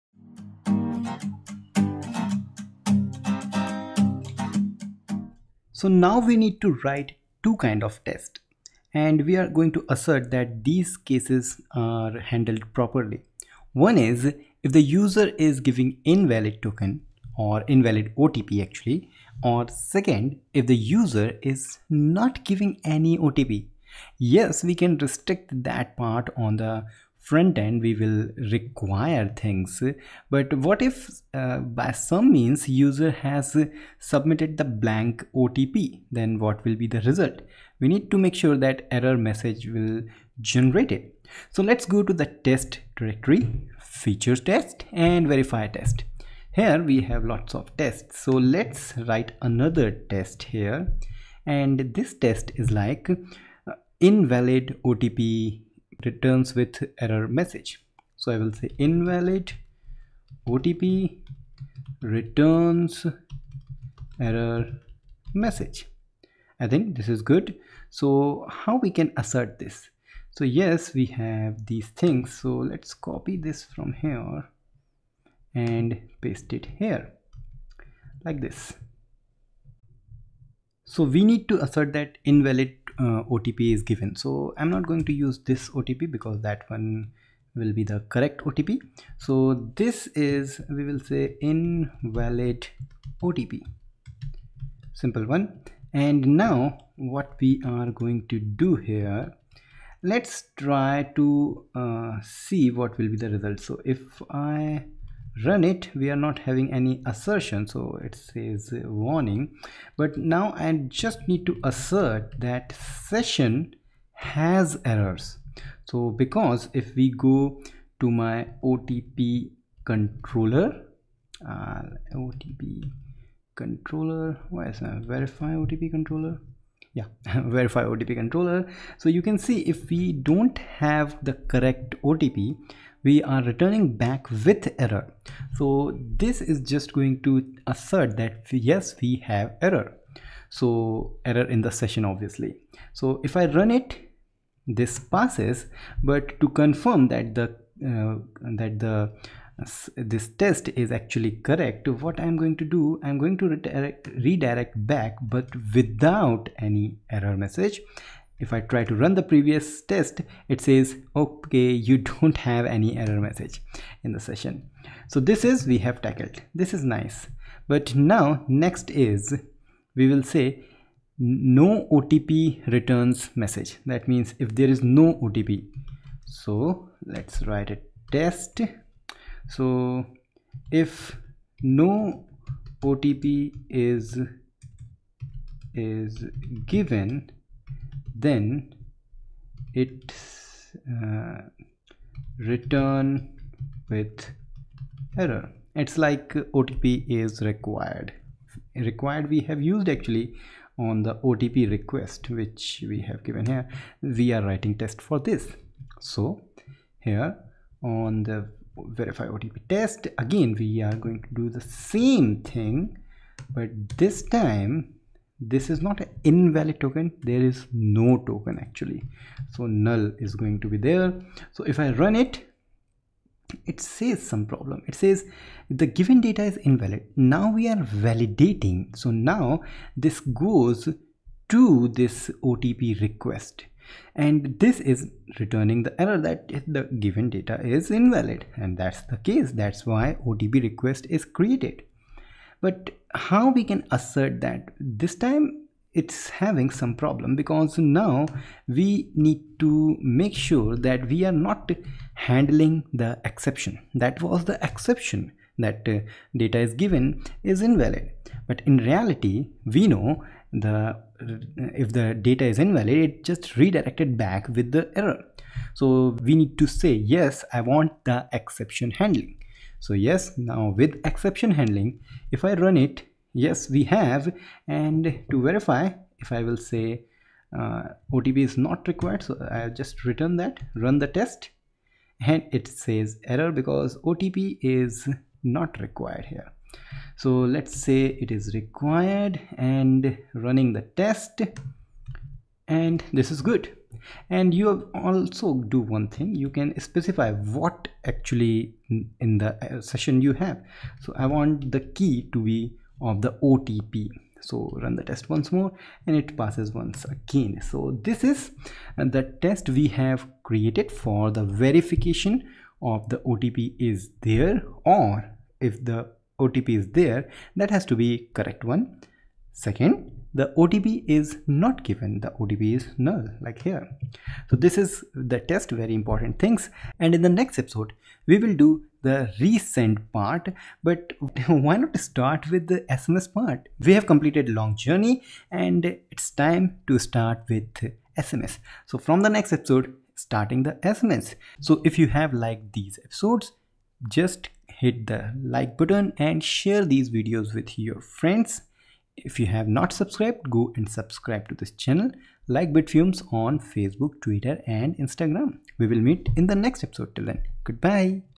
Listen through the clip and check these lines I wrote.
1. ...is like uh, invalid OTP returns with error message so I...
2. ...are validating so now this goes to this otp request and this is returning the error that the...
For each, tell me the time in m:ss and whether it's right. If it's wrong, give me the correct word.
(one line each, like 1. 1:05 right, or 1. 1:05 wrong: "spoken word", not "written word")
1. 0:52 right
2. 3:47 right.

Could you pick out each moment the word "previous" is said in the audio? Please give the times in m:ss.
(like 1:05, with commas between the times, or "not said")
2:39.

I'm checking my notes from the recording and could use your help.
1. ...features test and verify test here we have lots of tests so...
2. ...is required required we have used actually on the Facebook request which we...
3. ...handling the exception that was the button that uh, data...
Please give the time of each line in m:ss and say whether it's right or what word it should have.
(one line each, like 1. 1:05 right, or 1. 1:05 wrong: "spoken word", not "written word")
1. 0:43 right
2. 3:17 wrong: "OTP", not "Facebook"
3. 4:12 wrong: "exception", not "button".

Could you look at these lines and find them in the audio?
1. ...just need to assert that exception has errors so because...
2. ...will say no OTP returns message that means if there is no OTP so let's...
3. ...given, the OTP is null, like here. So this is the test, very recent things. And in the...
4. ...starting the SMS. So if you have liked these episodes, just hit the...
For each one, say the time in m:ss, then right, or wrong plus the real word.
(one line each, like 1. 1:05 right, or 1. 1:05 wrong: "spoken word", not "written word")
1. 1:50 wrong: "session", not "exception"
2. 2:50 right
3. 5:21 wrong: "important", not "recent"
4. 5:40 right.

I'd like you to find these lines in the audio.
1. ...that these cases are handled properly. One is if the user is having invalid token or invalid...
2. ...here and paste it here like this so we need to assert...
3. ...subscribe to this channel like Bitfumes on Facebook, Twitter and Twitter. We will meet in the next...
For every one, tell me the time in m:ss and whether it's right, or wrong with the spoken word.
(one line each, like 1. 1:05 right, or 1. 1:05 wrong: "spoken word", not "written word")
1. 0:10 wrong: "giving", not "having"
2. 1:13 right
3. 5:50 wrong: "Instagram", not "Twitter".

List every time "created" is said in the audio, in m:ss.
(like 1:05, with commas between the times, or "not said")
4:01, 5:10.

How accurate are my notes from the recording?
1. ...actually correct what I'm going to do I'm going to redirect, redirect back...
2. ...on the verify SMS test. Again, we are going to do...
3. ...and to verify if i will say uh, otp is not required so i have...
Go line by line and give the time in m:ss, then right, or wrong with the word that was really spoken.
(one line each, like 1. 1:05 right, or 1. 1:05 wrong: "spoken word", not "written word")
1. 2:30 right
2. 3:27 wrong: "OTP", not "SMS"
3. 4:34 right.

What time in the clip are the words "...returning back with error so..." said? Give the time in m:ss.
2:13.